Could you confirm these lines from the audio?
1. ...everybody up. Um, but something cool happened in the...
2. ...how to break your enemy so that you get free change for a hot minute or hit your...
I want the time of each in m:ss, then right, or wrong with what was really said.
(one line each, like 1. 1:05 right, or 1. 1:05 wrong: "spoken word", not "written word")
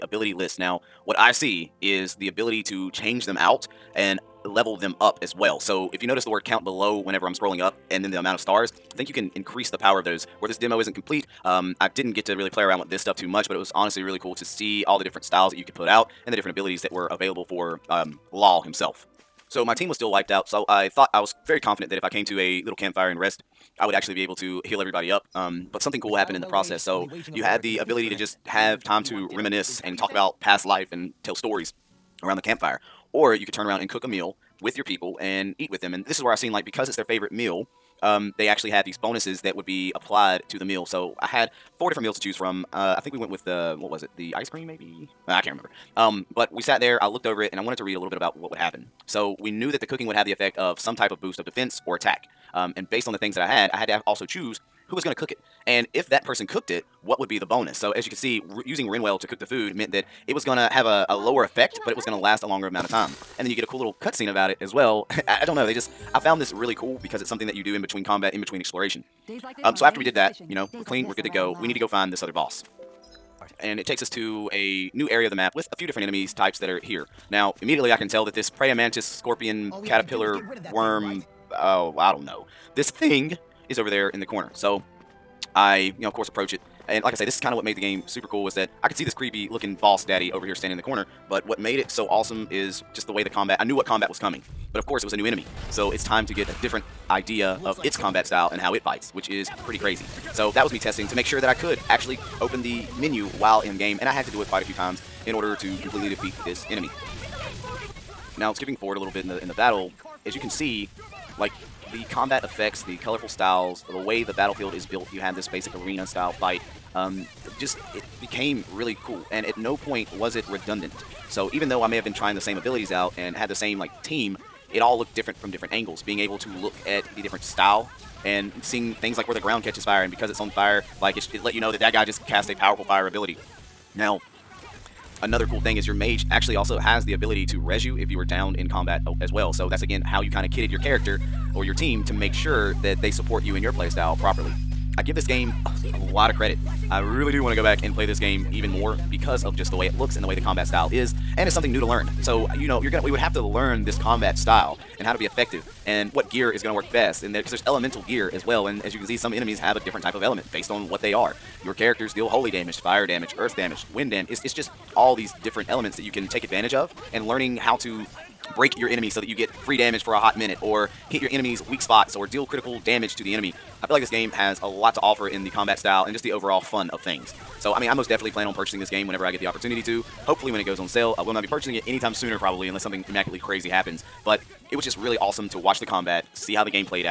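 1. 0:24 right
2. 2:47 wrong: "damage", not "change".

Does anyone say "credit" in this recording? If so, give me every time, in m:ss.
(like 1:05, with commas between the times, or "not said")
2:26.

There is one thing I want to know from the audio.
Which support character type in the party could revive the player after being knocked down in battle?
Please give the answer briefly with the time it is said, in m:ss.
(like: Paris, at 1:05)
mage, at 2:15.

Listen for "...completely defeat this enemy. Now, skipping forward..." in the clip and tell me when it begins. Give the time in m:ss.
1:45.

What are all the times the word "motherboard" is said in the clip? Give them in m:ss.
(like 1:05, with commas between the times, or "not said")
not said.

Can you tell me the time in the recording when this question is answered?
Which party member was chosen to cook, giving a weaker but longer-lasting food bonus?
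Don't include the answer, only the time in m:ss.
0:58.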